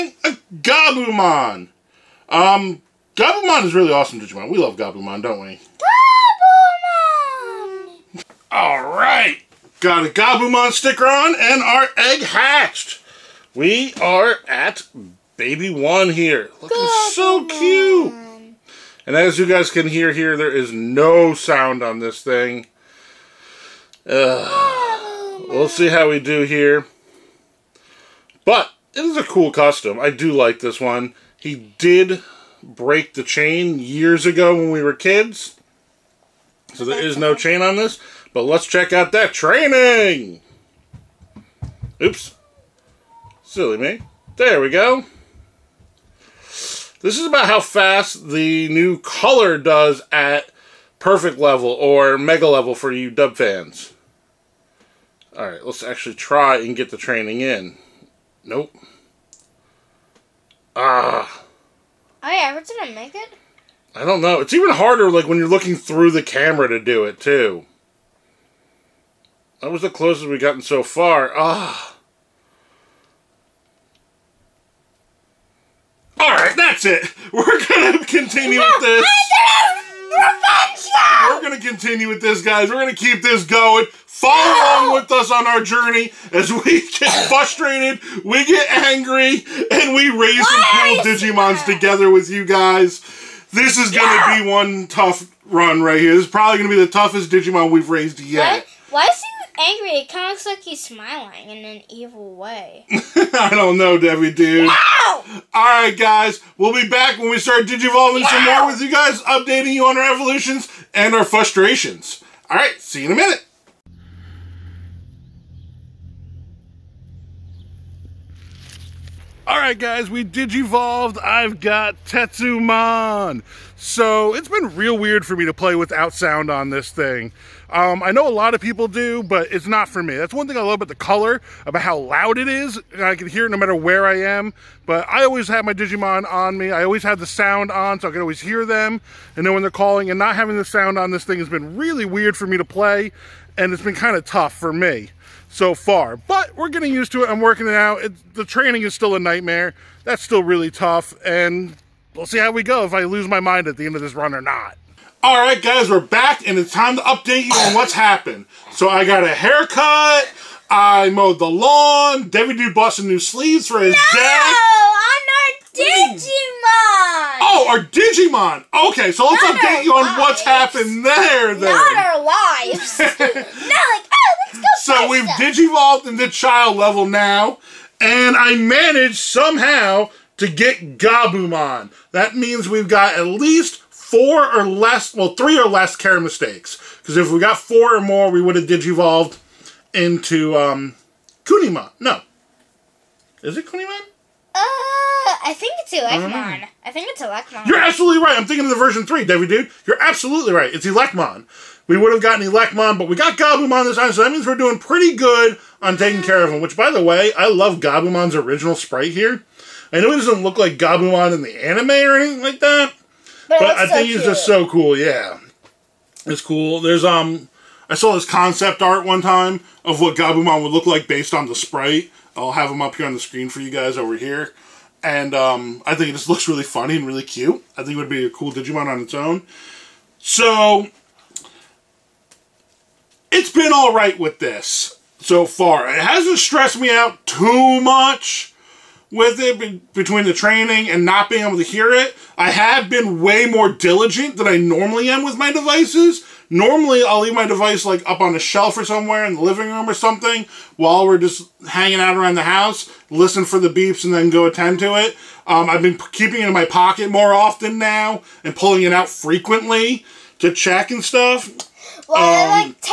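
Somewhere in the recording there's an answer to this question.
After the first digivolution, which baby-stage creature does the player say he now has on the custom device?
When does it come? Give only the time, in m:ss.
2:02.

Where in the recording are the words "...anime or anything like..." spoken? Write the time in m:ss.
3:31.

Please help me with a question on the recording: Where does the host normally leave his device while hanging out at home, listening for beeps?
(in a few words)
On a shelf.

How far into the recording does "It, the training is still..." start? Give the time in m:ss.
2:28.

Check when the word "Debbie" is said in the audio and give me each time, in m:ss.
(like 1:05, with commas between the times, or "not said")
1:43, 3:19.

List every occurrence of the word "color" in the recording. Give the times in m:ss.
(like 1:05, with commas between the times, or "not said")
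0:48, 2:10.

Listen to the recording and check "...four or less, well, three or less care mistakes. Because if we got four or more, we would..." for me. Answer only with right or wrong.
right.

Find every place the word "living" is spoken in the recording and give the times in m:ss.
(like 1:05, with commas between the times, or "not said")
4:09.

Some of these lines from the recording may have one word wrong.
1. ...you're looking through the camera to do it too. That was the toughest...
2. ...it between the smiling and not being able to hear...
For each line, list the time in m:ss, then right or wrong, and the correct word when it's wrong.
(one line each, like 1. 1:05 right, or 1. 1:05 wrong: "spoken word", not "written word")
1. 1:05 wrong: "closest", not "toughest"
2. 3:59 wrong: "training", not "smiling".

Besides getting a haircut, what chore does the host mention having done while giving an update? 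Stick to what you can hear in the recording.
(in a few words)
Mowed the lawn.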